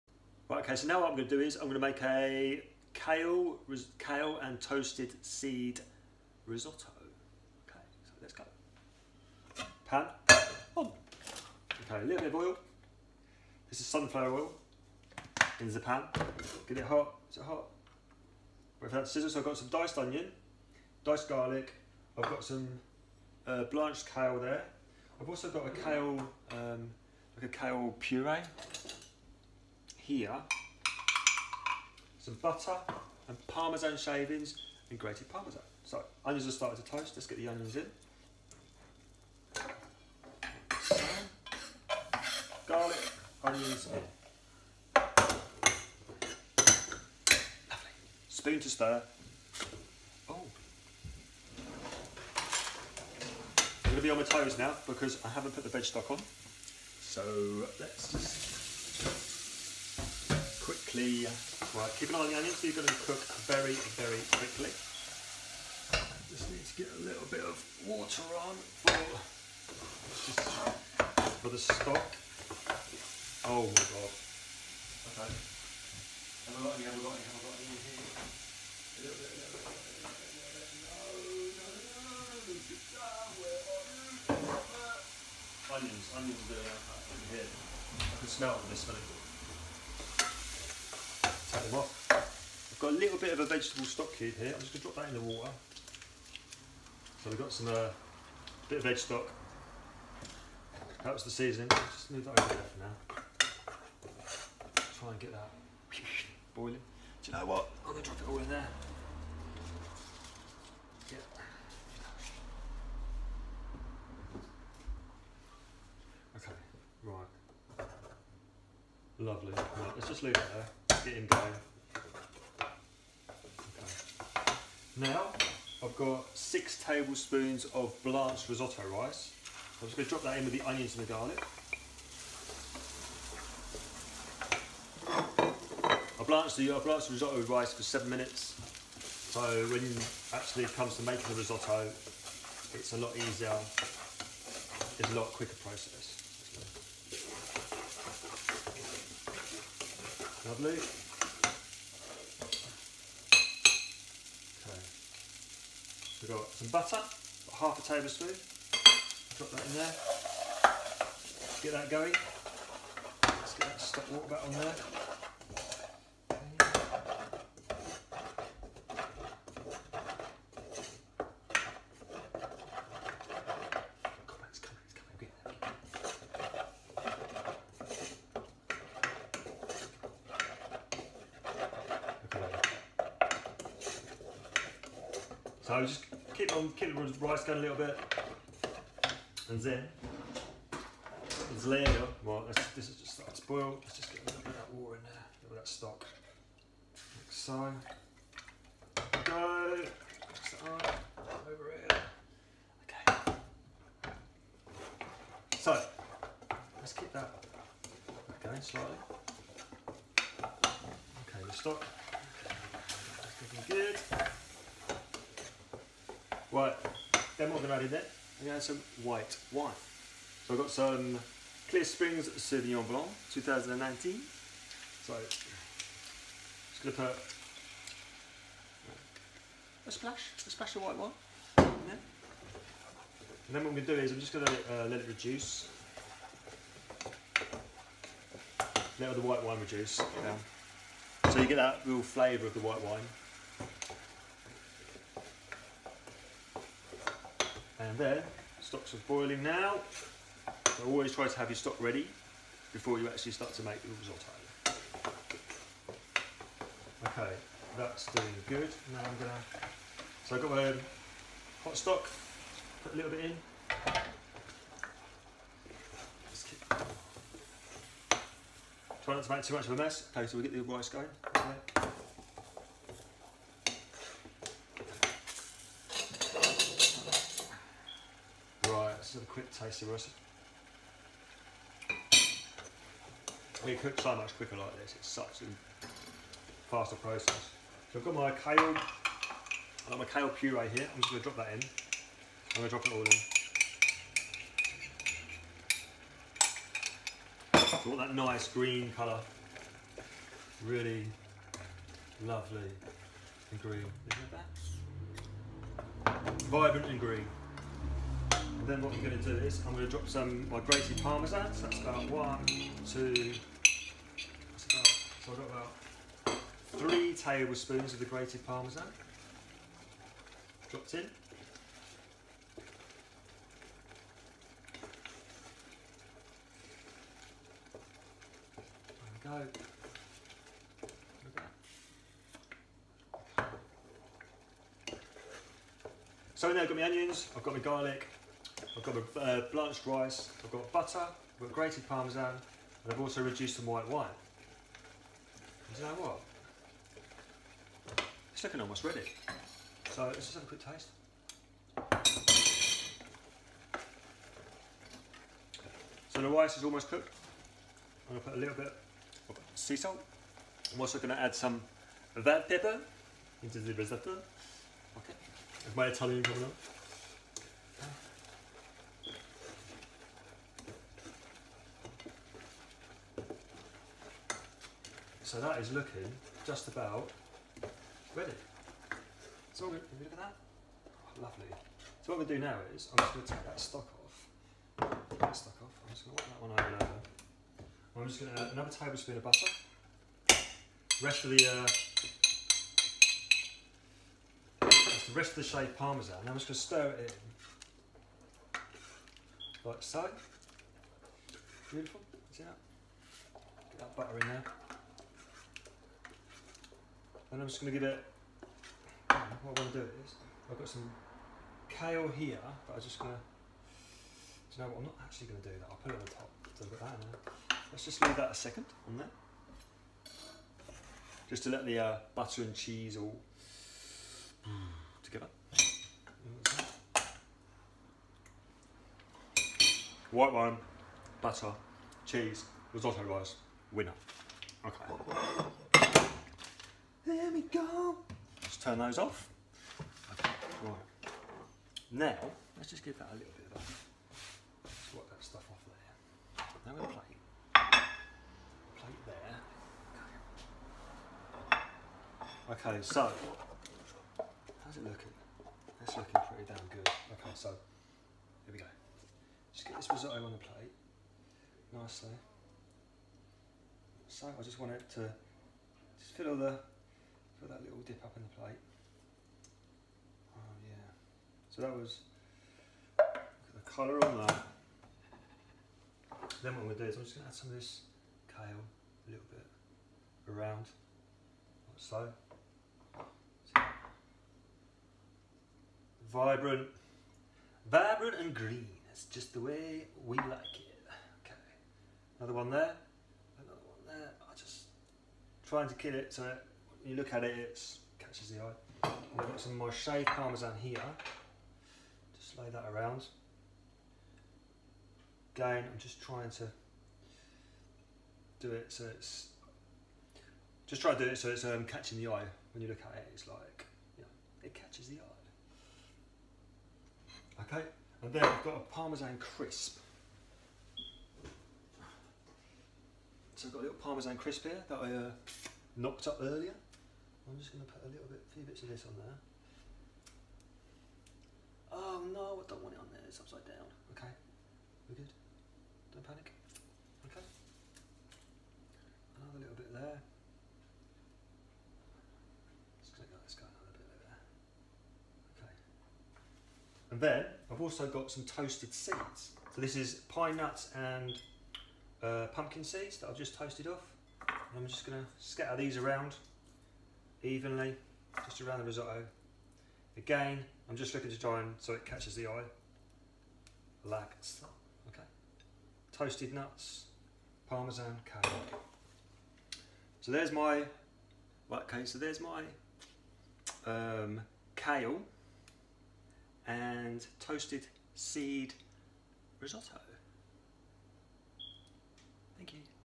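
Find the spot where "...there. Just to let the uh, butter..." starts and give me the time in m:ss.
6:58.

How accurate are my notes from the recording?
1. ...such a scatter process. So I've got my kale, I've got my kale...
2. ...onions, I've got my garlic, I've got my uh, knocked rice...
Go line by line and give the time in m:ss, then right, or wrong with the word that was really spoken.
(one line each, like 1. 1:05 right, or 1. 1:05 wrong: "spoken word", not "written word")
1. 4:45 wrong: "faster", not "scatter"
2. 5:36 wrong: "blanched", not "knocked".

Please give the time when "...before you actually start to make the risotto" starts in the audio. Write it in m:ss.
4:12.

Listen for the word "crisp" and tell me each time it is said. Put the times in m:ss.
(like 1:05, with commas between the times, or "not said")
8:39, 8:44.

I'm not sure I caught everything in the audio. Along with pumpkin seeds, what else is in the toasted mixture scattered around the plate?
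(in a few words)
pine nuts.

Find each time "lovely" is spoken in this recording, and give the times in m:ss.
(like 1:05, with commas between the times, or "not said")
0:47, 1:59, 2:30, 5:02, 6:21.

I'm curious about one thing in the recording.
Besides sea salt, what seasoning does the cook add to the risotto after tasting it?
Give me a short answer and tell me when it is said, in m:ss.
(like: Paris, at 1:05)
red pepper, at 6:02.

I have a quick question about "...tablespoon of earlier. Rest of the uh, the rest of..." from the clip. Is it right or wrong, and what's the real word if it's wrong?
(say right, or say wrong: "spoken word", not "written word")
wrong: "butter", not "earlier".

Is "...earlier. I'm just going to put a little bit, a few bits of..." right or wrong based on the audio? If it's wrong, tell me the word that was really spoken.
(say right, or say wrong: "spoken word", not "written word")
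right.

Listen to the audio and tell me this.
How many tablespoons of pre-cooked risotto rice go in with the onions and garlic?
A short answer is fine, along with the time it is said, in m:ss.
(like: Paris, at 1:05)
6, at 2:06.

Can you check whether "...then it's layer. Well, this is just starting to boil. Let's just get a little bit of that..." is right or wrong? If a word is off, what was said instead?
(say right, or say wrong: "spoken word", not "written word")
right.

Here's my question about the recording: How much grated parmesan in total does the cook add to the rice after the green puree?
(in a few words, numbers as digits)
3 tablespoons.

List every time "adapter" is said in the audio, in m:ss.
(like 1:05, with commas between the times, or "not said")
not said.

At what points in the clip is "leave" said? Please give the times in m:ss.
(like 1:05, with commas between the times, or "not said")
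2:00, 6:58.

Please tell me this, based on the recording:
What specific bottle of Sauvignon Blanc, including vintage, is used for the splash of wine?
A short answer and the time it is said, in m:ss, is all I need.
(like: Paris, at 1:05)
Clear Springs Sauvignon Blanc 2019, at 3:41.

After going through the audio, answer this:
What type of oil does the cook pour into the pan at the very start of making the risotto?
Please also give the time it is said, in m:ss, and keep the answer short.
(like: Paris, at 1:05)
sunflower oil, at 0:13.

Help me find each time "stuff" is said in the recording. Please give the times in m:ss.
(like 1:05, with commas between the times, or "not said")
7:25.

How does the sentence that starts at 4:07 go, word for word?
And then, stocks are boiling now.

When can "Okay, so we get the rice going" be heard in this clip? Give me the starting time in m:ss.
4:30.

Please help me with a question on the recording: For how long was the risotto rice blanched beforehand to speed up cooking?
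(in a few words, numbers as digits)
7 minutes.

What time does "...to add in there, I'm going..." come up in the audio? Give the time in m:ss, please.
3:37.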